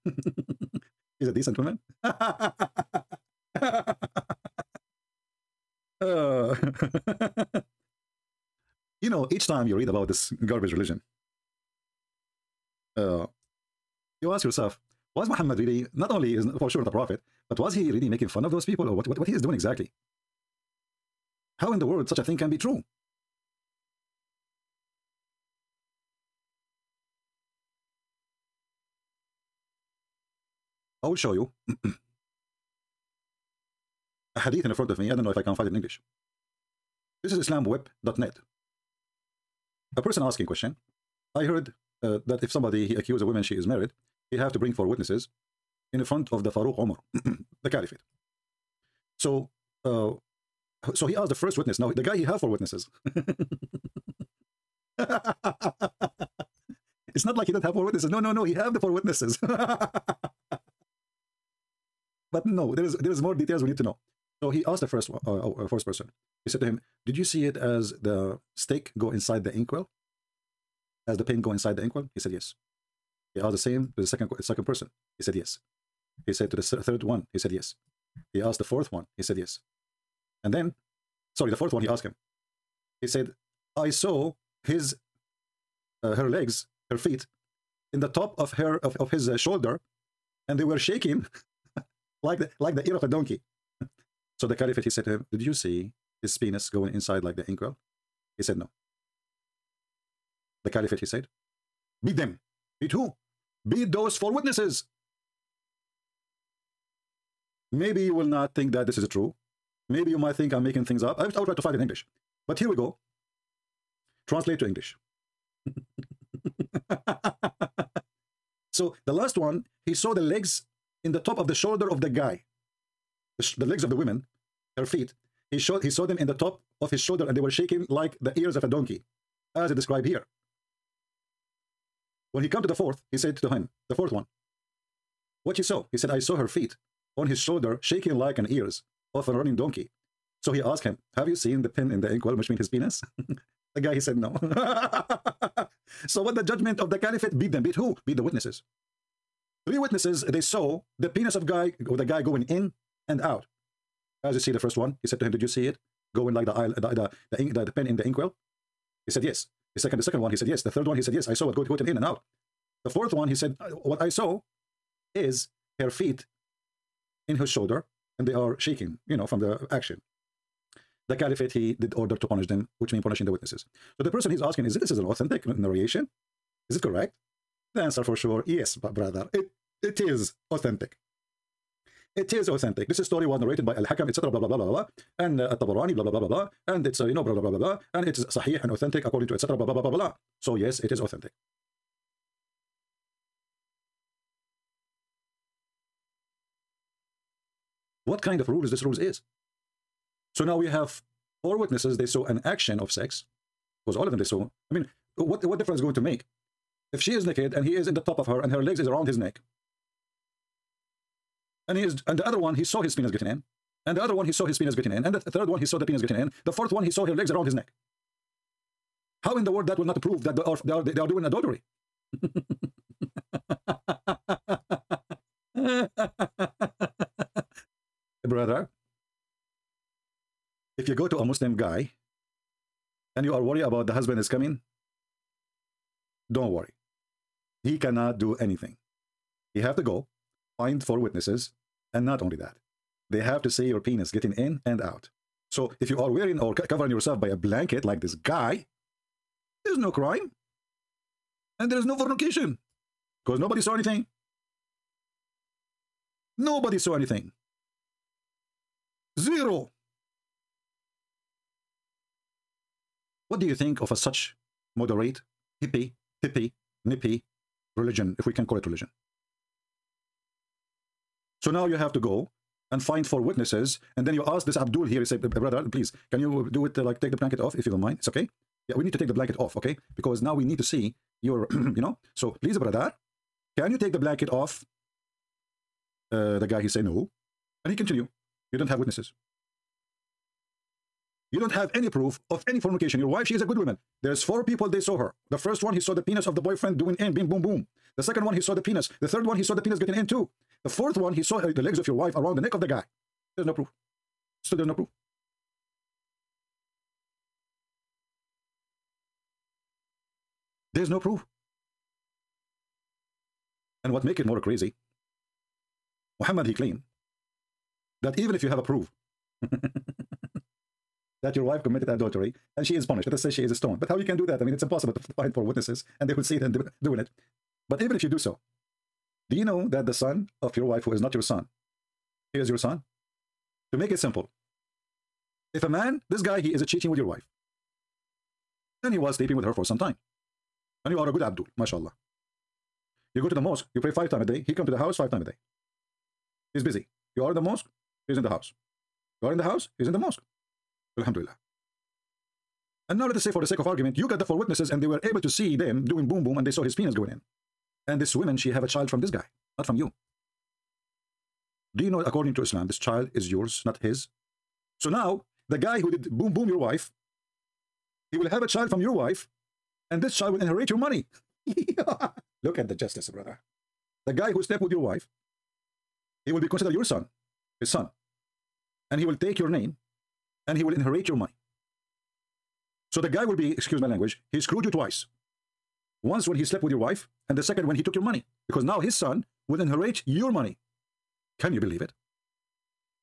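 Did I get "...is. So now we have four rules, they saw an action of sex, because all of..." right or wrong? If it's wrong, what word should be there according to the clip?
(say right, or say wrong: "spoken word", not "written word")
wrong: "witnesses", not "rules".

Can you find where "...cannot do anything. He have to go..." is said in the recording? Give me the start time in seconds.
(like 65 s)
237 s.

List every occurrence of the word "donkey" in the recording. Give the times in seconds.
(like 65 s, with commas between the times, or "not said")
93 s, 128 s, 139 s.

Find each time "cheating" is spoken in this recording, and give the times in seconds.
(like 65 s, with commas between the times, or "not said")
336 s.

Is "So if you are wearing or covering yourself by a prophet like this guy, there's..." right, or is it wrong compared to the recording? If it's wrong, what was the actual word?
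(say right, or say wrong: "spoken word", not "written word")
wrong: "blanket", not "prophet".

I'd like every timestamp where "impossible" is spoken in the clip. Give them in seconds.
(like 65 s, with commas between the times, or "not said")
324 s.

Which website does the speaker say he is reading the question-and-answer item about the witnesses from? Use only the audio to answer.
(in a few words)
islamweb.net.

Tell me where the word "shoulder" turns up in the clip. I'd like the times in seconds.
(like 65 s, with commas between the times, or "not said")
89 s, 121 s, 126 s, 137 s, 167 s.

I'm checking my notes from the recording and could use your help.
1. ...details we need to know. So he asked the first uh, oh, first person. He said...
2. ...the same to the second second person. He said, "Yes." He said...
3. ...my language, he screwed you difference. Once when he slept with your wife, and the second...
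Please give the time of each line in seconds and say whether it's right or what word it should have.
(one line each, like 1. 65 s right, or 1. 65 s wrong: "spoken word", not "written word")
1. 63 s right
2. 73 s right
3. 383 s wrong: "twice", not "difference".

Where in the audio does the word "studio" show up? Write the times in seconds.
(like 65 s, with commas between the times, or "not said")
not said.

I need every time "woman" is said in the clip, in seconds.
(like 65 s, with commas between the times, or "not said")
1 s, 43 s, 293 s, 358 s.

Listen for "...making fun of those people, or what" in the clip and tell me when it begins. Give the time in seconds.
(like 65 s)
18 s.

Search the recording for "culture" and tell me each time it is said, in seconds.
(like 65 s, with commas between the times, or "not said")
not said.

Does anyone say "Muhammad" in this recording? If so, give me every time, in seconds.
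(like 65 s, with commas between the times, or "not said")
15 s, 316 s.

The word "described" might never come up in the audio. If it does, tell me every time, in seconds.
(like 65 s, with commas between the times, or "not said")
129 s.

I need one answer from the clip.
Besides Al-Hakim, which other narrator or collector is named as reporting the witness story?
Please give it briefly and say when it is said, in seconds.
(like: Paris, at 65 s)
Al-Tabarani, at 185 s.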